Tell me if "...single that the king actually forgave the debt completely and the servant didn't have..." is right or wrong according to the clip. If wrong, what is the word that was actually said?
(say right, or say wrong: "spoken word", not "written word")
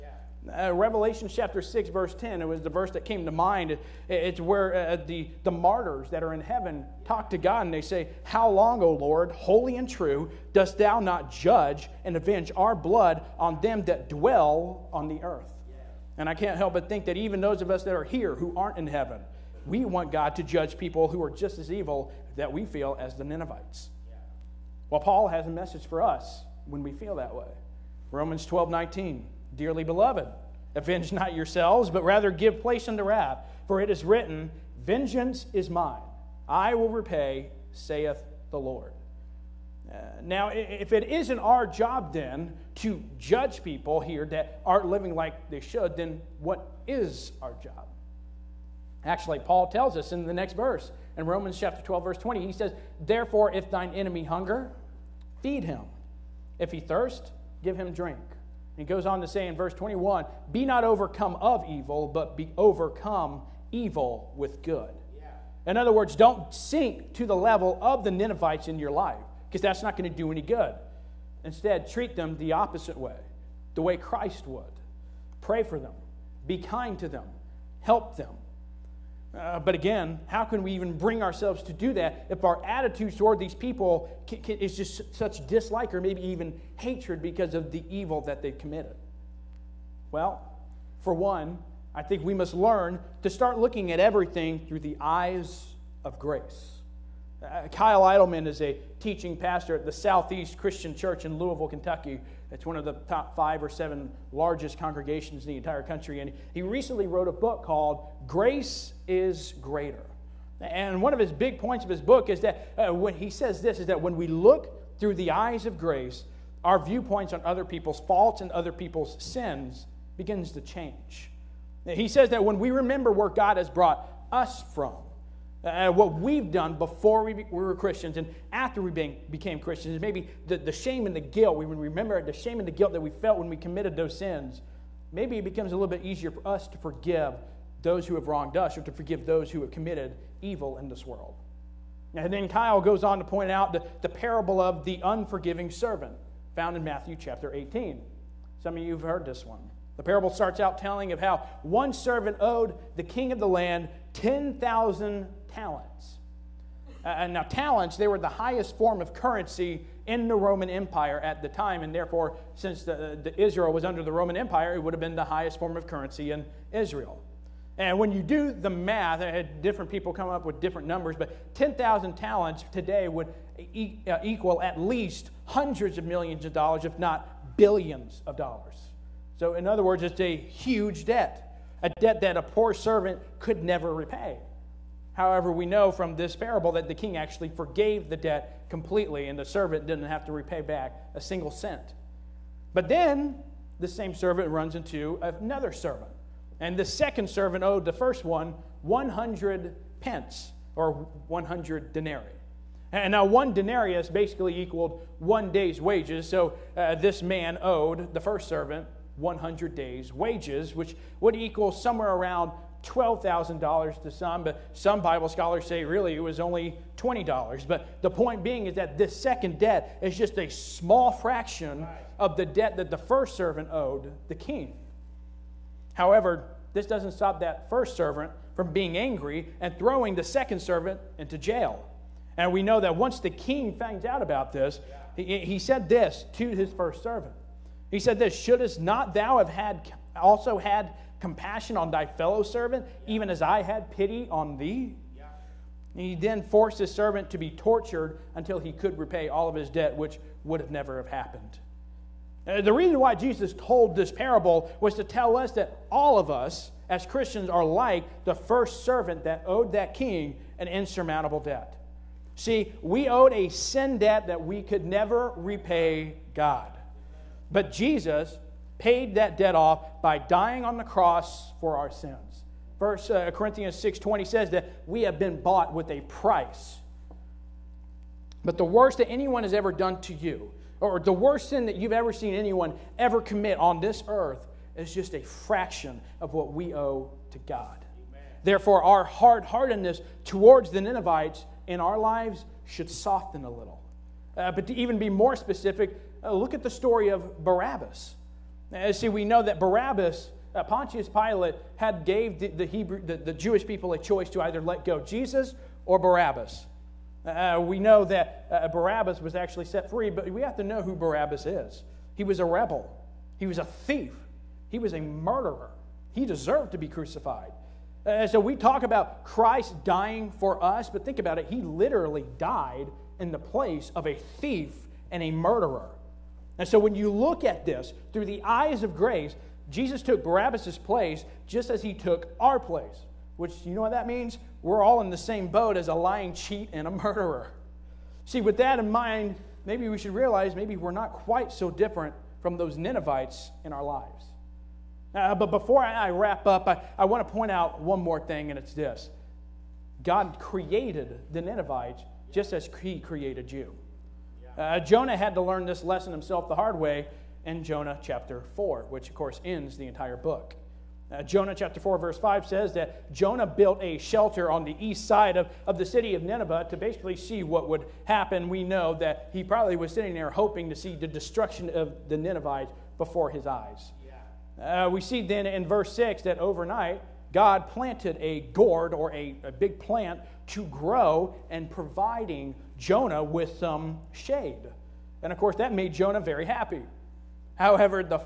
wrong: "parable", not "single".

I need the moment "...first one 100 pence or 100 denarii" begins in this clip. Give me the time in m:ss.
3:17.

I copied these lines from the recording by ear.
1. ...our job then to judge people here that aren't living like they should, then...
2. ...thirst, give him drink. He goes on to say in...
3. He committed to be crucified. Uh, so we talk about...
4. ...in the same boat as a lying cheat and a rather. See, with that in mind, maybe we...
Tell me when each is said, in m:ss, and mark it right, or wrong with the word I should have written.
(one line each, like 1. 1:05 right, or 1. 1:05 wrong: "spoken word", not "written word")
1. 0:41 right
2. 0:56 right
3. 5:16 wrong: "deserved", not "committed"
4. 5:35 wrong: "murderer", not "rather".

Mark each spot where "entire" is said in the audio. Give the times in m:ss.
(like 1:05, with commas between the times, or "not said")
1:45, 5:59.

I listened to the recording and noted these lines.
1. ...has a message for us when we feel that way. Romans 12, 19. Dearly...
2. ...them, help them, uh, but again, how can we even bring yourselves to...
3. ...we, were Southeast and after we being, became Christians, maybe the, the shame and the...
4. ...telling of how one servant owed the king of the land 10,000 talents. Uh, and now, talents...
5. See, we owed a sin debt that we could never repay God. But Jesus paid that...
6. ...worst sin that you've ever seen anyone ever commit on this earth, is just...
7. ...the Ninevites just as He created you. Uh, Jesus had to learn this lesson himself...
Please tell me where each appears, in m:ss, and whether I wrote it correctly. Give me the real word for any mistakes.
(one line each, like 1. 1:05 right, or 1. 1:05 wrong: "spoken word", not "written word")
1. 0:25 right
2. 1:17 wrong: "ourselves", not "yourselves"
3. 2:07 wrong: "Christians", not "Southeast"
4. 2:30 right
5. 4:22 right
6. 4:41 right
7. 5:51 wrong: "Jonah", not "Jesus".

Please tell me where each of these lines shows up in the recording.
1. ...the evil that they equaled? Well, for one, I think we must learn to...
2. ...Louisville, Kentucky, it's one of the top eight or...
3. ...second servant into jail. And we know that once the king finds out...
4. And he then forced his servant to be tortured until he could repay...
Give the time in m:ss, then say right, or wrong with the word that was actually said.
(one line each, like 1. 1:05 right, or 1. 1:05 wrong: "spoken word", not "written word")
1. 1:27 wrong: "committed", not "equaled"
2. 1:41 wrong: "five", not "eight"
3. 3:50 right
4. 4:05 right.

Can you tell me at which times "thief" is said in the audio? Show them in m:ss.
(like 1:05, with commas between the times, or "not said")
5:13, 5:24.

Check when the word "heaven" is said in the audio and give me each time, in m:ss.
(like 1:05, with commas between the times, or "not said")
0:06, 0:18.